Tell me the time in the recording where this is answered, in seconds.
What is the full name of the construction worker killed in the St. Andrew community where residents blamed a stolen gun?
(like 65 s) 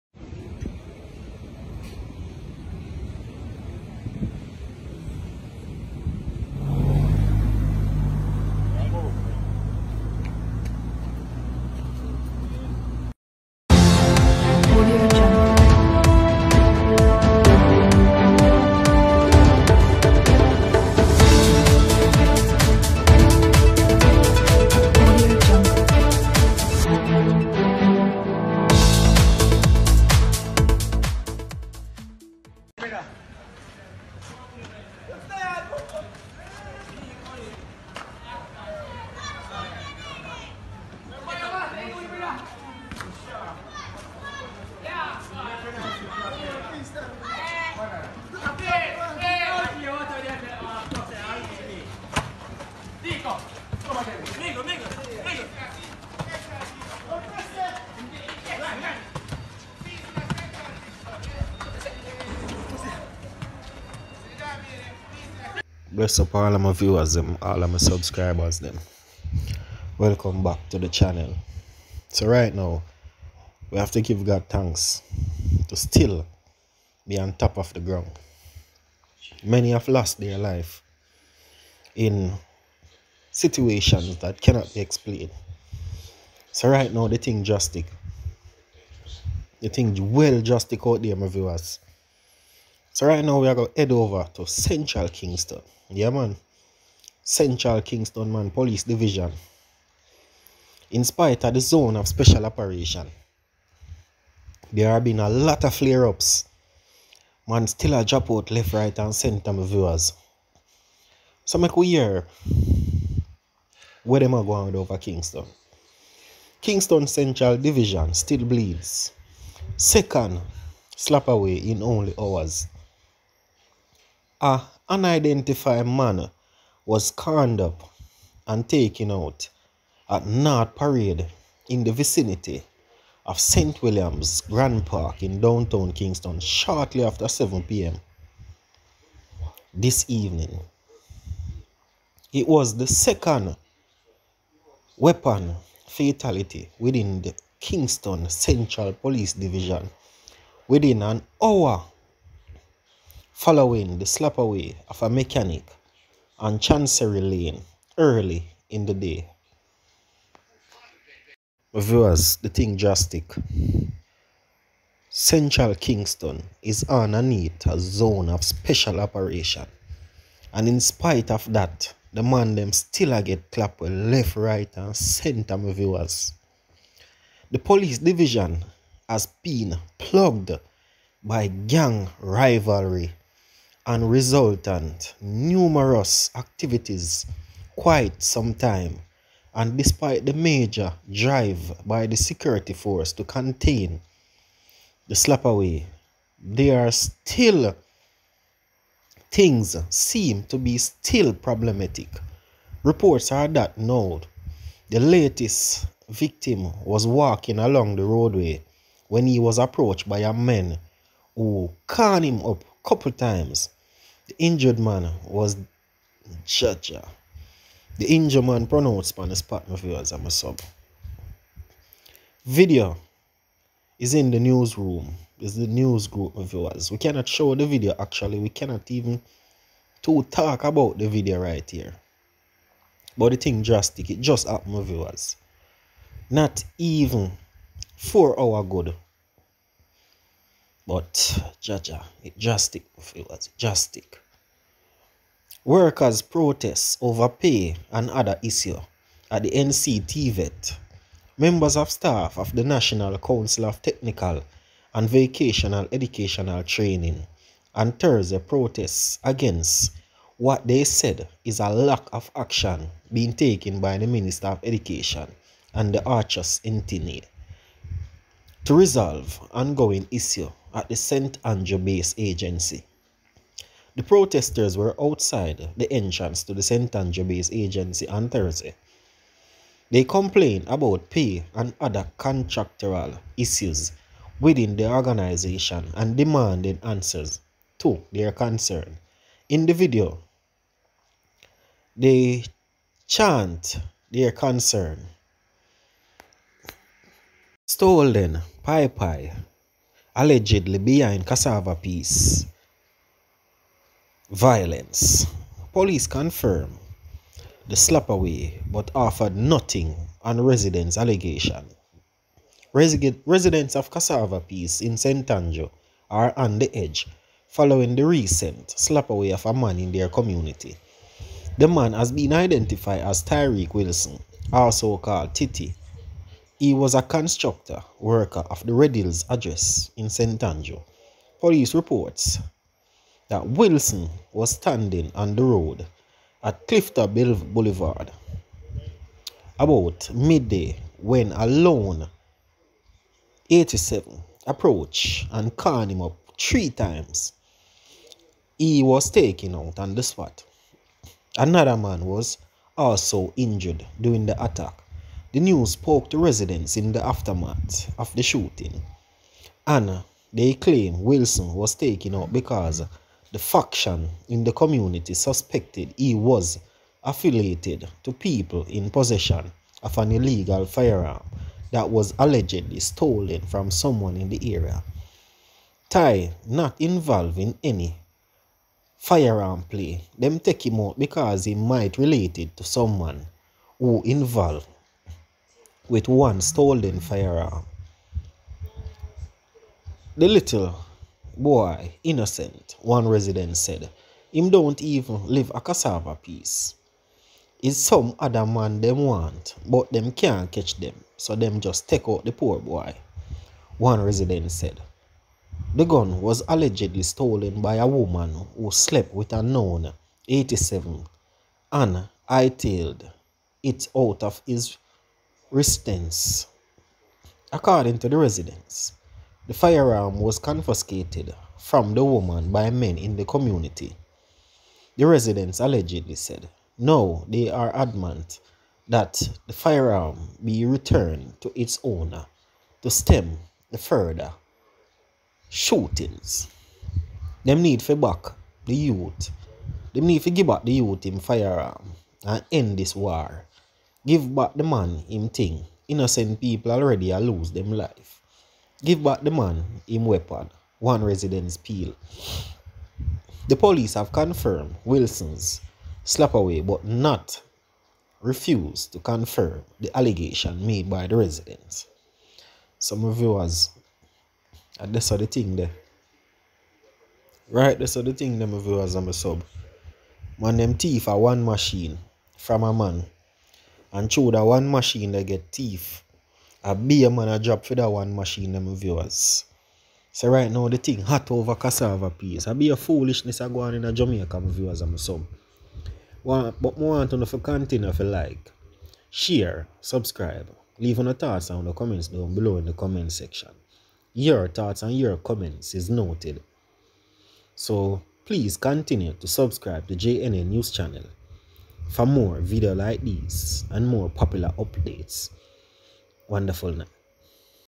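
323 s.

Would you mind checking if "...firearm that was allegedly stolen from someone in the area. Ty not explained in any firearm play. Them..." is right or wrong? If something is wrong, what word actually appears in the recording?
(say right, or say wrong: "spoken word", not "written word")
wrong: "involved", not "explained".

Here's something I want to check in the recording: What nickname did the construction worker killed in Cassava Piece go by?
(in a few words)
Titi.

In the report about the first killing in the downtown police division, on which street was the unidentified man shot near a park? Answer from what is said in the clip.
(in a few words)
North Parade.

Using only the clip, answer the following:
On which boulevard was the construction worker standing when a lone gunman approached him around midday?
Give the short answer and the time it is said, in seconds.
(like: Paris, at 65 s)
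Clifton Boulevard, at 336 s.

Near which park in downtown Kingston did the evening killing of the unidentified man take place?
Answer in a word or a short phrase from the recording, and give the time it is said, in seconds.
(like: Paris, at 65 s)
St. William's Grant Park, at 133 s.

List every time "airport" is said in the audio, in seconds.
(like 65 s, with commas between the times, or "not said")
not said.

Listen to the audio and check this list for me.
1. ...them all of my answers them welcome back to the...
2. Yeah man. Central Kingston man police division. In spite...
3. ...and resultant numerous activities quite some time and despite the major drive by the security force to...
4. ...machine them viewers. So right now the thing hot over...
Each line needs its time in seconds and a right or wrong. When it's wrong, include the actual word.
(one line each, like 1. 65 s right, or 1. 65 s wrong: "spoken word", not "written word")
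1. 67 s wrong: "subscribers", not "answers"
2. 95 s right
3. 183 s right
4. 478 s right.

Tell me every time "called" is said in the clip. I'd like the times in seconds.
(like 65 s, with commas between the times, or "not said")
211 s, 324 s, 345 s.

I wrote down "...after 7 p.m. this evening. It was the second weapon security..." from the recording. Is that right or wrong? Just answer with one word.
wrong.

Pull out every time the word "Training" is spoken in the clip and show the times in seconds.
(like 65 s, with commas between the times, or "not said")
256 s.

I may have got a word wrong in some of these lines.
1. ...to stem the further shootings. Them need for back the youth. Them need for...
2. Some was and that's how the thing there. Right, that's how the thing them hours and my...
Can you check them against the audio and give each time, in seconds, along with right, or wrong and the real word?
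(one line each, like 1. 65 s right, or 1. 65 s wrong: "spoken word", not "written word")
1. 432 s right
2. 462 s wrong: "viewers", not "hours".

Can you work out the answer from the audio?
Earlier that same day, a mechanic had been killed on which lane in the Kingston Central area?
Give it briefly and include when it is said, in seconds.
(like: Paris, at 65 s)
Chancery Lane, at 156 s.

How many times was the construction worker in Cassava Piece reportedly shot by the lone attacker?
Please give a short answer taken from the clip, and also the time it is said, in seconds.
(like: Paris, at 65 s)
3, at 346 s.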